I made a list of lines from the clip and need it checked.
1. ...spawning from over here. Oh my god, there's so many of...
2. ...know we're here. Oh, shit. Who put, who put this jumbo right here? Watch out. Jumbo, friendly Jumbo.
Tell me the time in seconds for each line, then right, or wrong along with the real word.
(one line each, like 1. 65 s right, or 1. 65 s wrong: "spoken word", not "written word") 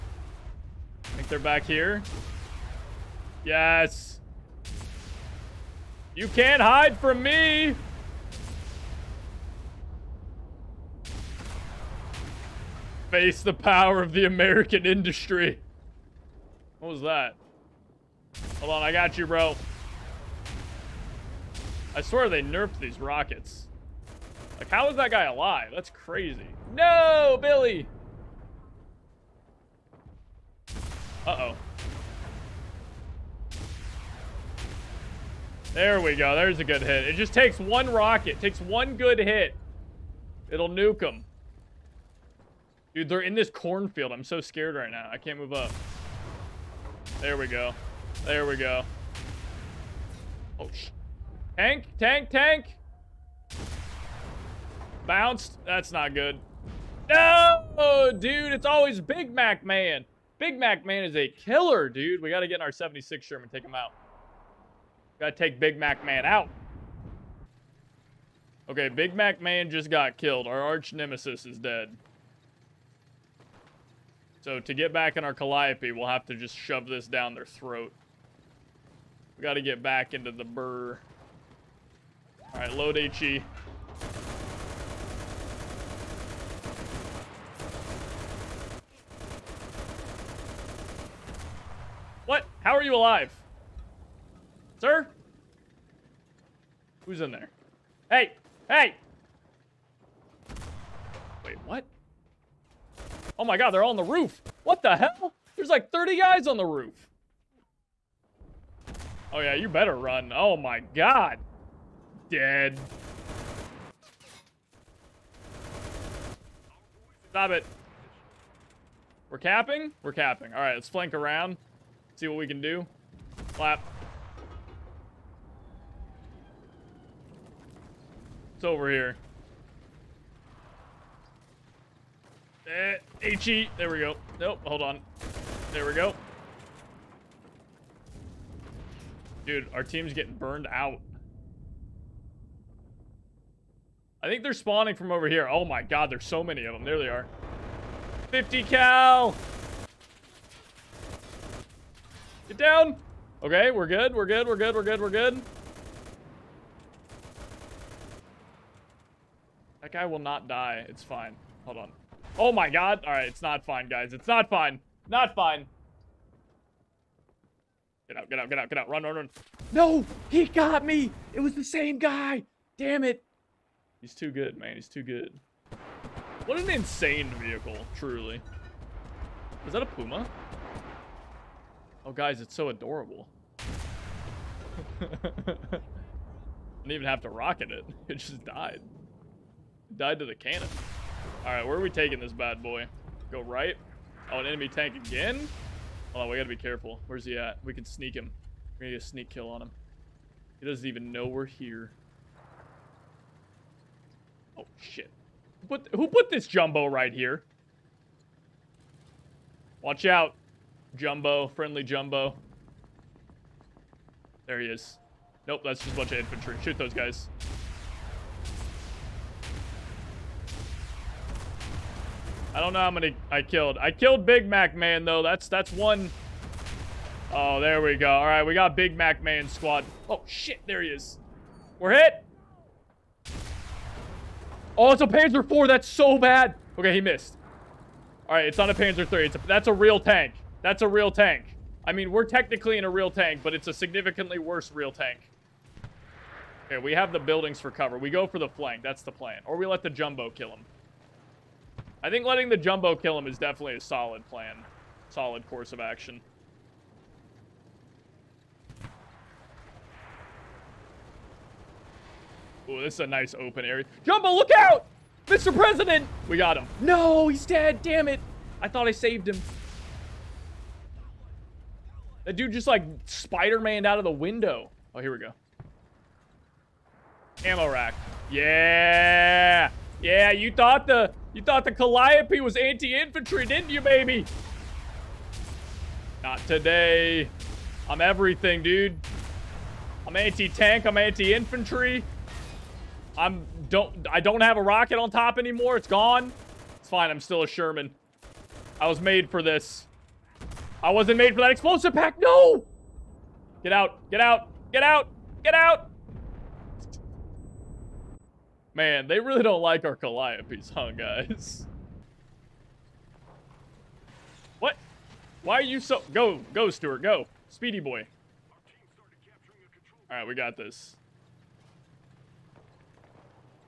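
1. 144 s right
2. 201 s right.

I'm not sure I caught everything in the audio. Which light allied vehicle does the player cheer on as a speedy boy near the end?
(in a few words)
Stuart.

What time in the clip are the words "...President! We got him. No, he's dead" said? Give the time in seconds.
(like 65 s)
265 s.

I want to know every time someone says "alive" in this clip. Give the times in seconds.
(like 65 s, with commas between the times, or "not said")
25 s, 92 s.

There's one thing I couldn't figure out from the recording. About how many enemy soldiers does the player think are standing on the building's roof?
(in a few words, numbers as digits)
30.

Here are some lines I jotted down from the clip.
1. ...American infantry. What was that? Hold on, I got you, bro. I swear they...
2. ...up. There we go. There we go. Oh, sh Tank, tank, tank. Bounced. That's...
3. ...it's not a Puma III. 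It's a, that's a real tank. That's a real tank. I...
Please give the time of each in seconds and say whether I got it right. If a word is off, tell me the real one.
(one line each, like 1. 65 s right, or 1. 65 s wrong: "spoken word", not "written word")
1. 14 s wrong: "industry", not "infantry"
2. 45 s right
3. 238 s wrong: "Panzer", not "Puma".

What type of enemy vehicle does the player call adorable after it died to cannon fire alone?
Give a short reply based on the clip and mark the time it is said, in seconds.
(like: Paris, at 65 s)
Puma, at 179 s.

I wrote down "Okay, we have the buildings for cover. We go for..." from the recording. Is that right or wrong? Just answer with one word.
right.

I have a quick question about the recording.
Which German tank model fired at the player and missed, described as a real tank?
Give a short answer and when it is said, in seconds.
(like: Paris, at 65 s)
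Panzer IV, at 235 s.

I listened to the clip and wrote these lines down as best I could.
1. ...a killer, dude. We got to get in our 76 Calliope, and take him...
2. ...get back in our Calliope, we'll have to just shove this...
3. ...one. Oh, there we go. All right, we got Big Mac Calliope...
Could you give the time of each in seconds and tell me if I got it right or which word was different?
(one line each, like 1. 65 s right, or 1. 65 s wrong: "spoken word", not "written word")
1. 61 s wrong: "Sherman", not "Calliope"
2. 74 s right
3. 225 s wrong: "Man", not "Calliope".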